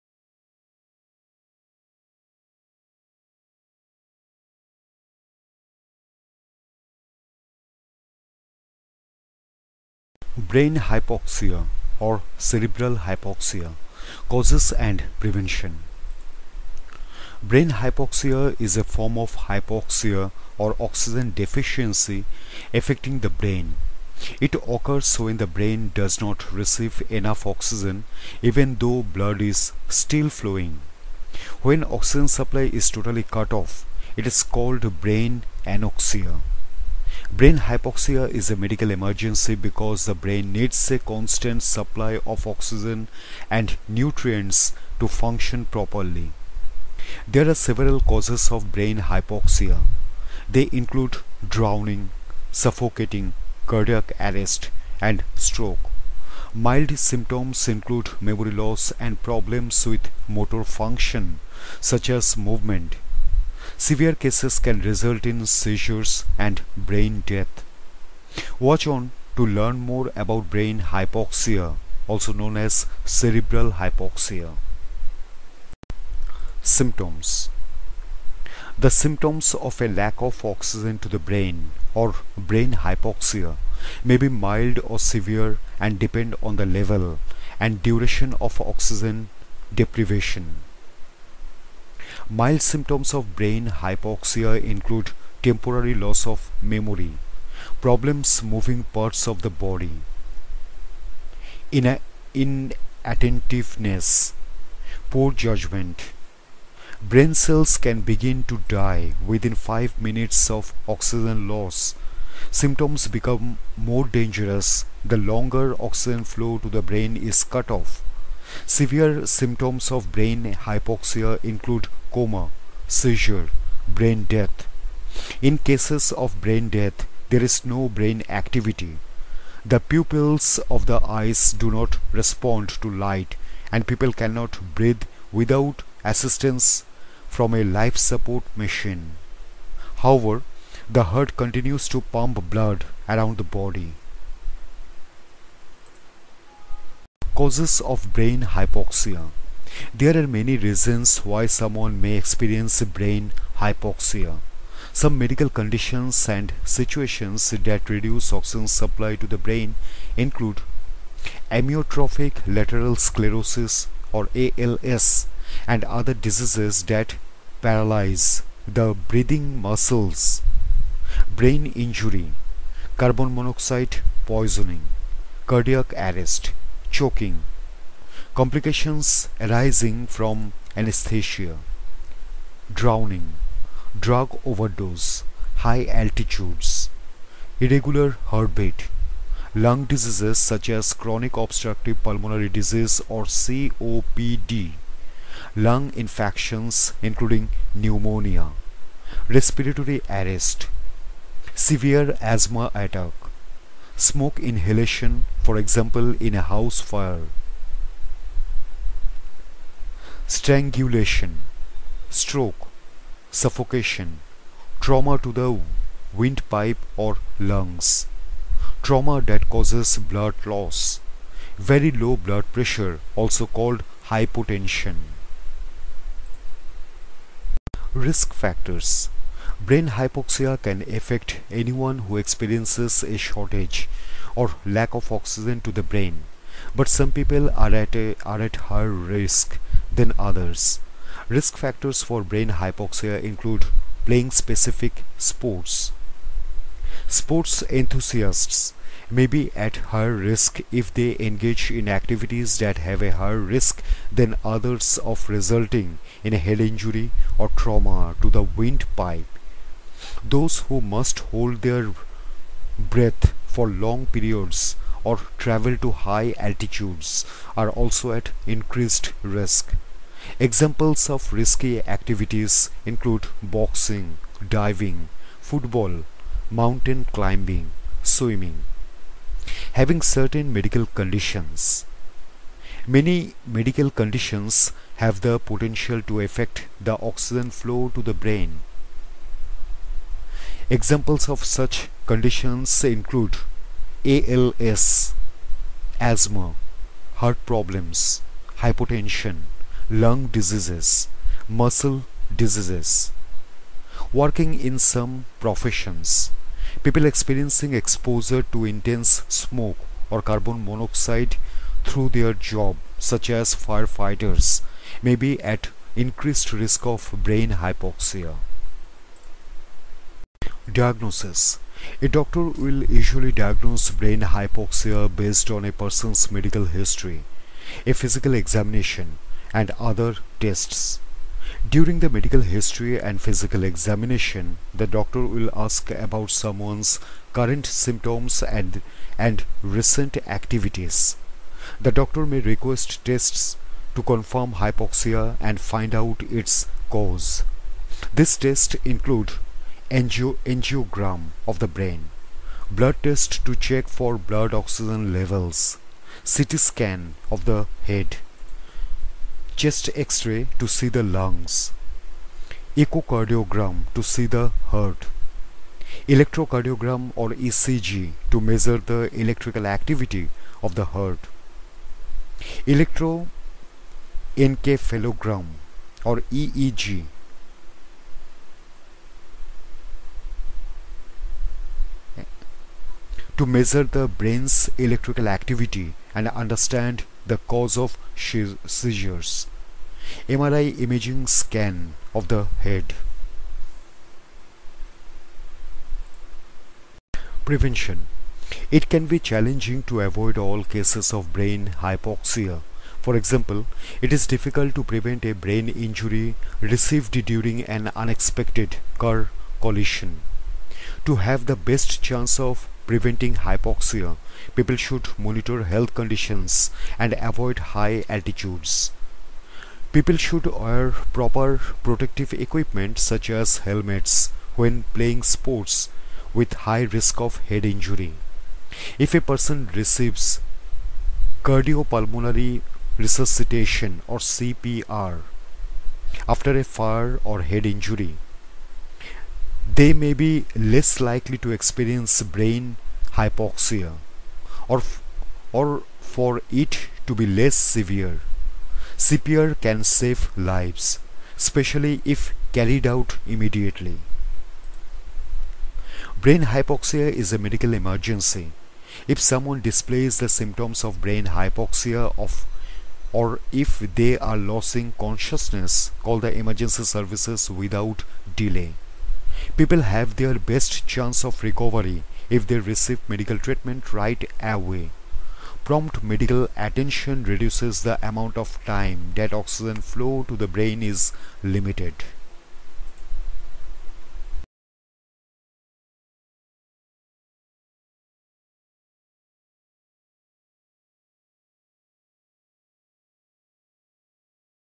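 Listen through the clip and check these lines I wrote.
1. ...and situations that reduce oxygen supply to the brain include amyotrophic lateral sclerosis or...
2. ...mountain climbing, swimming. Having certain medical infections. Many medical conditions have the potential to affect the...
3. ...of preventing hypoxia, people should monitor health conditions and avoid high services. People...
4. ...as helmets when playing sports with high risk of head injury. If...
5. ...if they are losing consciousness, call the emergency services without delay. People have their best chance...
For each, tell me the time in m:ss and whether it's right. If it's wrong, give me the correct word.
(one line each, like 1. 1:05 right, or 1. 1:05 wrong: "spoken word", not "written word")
1. 2:36 right
2. 4:36 wrong: "conditions", not "infections"
3. 6:52 wrong: "altitudes", not "services"
4. 7:03 right
5. 7:43 right.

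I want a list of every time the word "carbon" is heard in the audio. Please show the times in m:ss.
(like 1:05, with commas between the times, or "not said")
2:52, 5:10.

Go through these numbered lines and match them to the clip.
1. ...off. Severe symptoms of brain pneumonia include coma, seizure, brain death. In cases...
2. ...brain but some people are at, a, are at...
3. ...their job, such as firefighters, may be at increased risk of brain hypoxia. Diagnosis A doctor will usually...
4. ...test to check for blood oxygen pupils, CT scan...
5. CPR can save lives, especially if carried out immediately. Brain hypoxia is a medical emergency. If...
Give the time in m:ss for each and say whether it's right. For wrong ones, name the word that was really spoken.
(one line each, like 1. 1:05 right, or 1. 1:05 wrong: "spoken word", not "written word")
1. 1:57 wrong: "hypoxia", not "pneumonia"
2. 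3:55 right
3. 5:12 right
4. 5:53 wrong: "levels", not "pupils"
5. 7:29 right.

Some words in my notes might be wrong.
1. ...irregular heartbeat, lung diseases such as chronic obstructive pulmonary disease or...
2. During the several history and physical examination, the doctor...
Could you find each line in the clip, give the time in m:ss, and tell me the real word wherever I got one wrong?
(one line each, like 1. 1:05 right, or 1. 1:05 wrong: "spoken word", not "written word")
1. 3:07 right
2. 5:31 wrong: "medical", not "several".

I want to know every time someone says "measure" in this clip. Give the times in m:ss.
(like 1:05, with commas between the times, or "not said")
6:08, 6:23.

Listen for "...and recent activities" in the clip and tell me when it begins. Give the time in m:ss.
5:39.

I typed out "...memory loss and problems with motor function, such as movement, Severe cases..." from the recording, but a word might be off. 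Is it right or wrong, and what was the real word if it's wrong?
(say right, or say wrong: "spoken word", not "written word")
right.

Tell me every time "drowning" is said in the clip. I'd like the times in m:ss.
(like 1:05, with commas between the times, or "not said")
0:51, 3:02.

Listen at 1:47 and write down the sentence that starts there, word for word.
Brain cells can begin to die within 5 minutes of oxygen loss.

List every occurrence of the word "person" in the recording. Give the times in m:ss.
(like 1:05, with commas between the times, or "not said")
5:25, 7:09.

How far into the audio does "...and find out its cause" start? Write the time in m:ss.
5:45.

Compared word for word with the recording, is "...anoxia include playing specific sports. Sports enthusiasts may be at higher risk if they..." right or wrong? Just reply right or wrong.
wrong.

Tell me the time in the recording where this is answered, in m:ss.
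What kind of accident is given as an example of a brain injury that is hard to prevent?
6:48.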